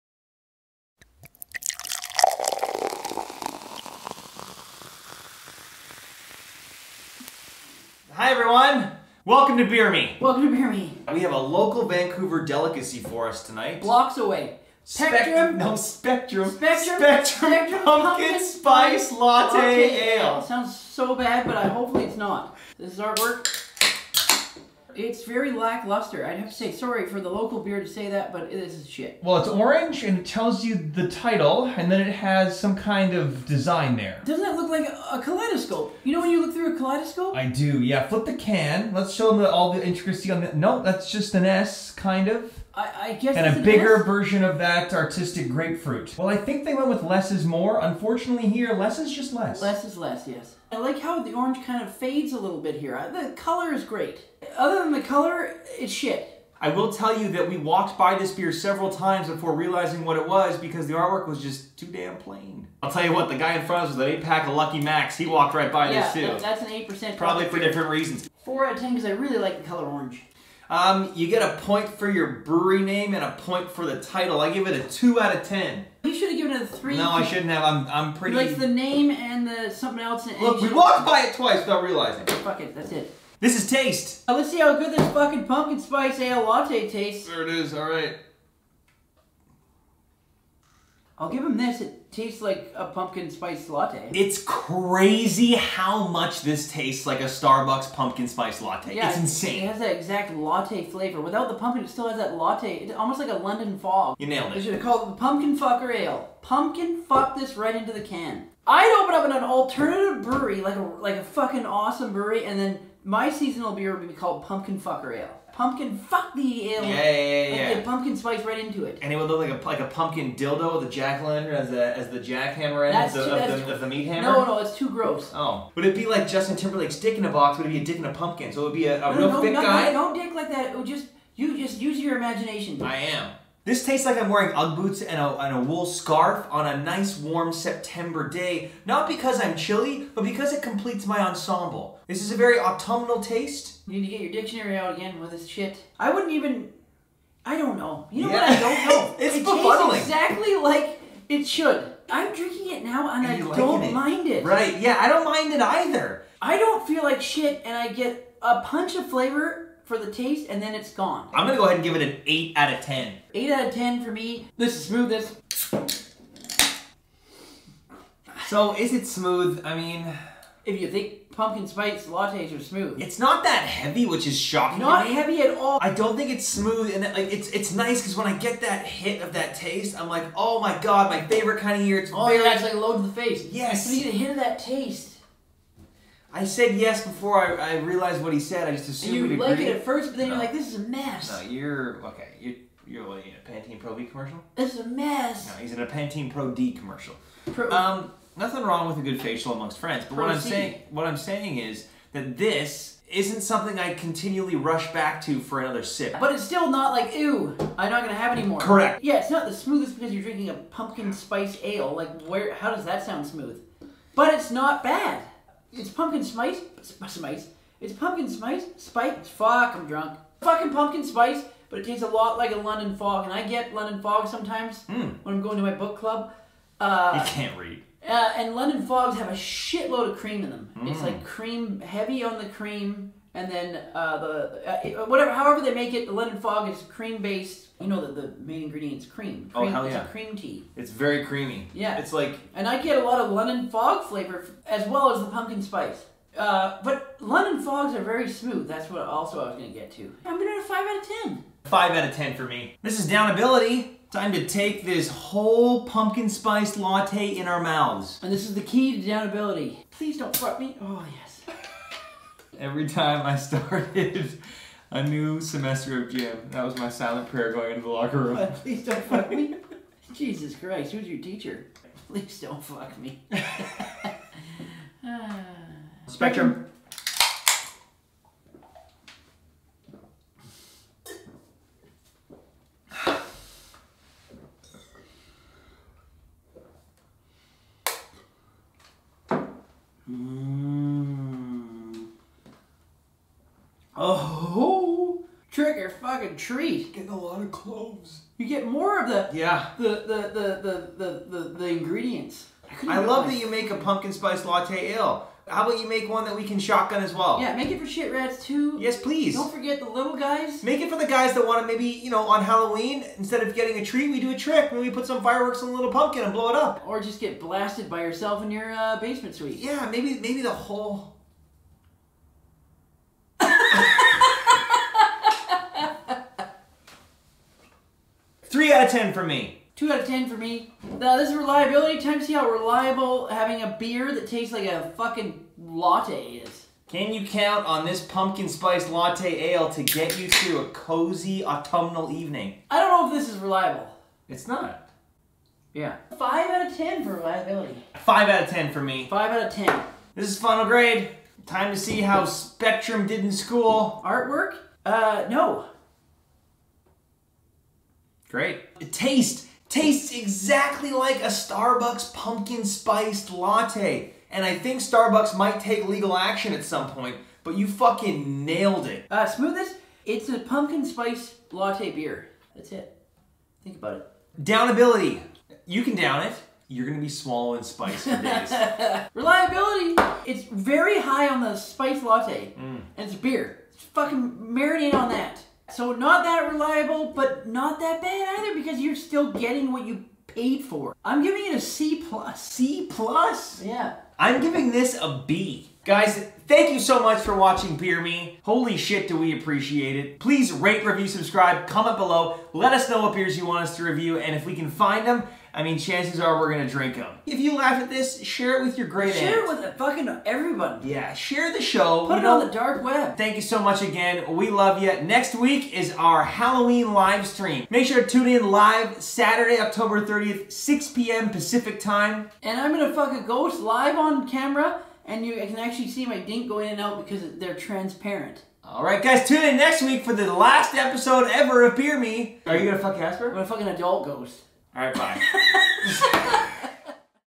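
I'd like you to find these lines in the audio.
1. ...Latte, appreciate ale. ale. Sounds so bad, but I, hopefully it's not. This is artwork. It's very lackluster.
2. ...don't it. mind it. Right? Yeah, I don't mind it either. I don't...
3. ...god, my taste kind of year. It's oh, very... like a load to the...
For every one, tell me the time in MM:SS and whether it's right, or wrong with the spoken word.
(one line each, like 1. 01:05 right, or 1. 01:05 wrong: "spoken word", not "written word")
1. 00:19 wrong: "latte", not "appreciate"
2. 02:33 right
3. 03:00 wrong: "favorite", not "taste".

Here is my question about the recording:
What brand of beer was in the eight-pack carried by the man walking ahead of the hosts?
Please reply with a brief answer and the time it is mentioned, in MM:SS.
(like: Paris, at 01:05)
Lucky, at 01:04.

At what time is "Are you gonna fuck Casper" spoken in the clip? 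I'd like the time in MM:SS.
07:12.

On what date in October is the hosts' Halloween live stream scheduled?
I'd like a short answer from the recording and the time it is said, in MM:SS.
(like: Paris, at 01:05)
October 30, at 06:59.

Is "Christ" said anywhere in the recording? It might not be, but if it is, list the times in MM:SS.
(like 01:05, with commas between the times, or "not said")
04:30.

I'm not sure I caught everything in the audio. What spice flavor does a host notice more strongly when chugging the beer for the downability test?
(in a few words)
Cloves.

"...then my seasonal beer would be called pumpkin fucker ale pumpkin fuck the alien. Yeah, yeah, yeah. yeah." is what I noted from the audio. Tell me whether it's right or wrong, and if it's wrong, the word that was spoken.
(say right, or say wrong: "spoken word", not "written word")
right.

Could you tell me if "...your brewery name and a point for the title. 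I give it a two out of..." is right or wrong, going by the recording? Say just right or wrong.
right.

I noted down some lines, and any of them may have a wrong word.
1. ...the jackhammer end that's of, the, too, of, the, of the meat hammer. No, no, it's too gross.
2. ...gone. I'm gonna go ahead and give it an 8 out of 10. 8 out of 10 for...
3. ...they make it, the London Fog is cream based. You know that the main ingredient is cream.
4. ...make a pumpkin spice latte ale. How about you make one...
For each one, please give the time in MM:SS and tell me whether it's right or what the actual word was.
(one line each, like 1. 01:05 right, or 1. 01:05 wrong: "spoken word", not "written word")
1. 02:02 right
2. 02:40 right
3. 03:55 right
4. 05:03 right.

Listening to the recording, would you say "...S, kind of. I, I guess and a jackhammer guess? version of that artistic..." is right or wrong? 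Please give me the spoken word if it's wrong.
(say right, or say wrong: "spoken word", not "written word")
wrong: "bigger", not "jackhammer".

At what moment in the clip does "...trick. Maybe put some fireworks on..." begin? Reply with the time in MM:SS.
05:14.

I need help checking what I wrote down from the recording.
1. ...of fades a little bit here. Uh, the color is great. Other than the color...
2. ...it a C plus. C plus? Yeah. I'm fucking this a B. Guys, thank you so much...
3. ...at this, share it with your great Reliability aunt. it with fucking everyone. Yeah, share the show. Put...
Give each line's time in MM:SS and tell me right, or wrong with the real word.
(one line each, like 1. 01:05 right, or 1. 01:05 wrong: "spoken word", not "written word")
1. 00:51 right
2. 06:31 wrong: "giving", not "fucking"
3. 06:47 wrong: "Share", not "Reliability".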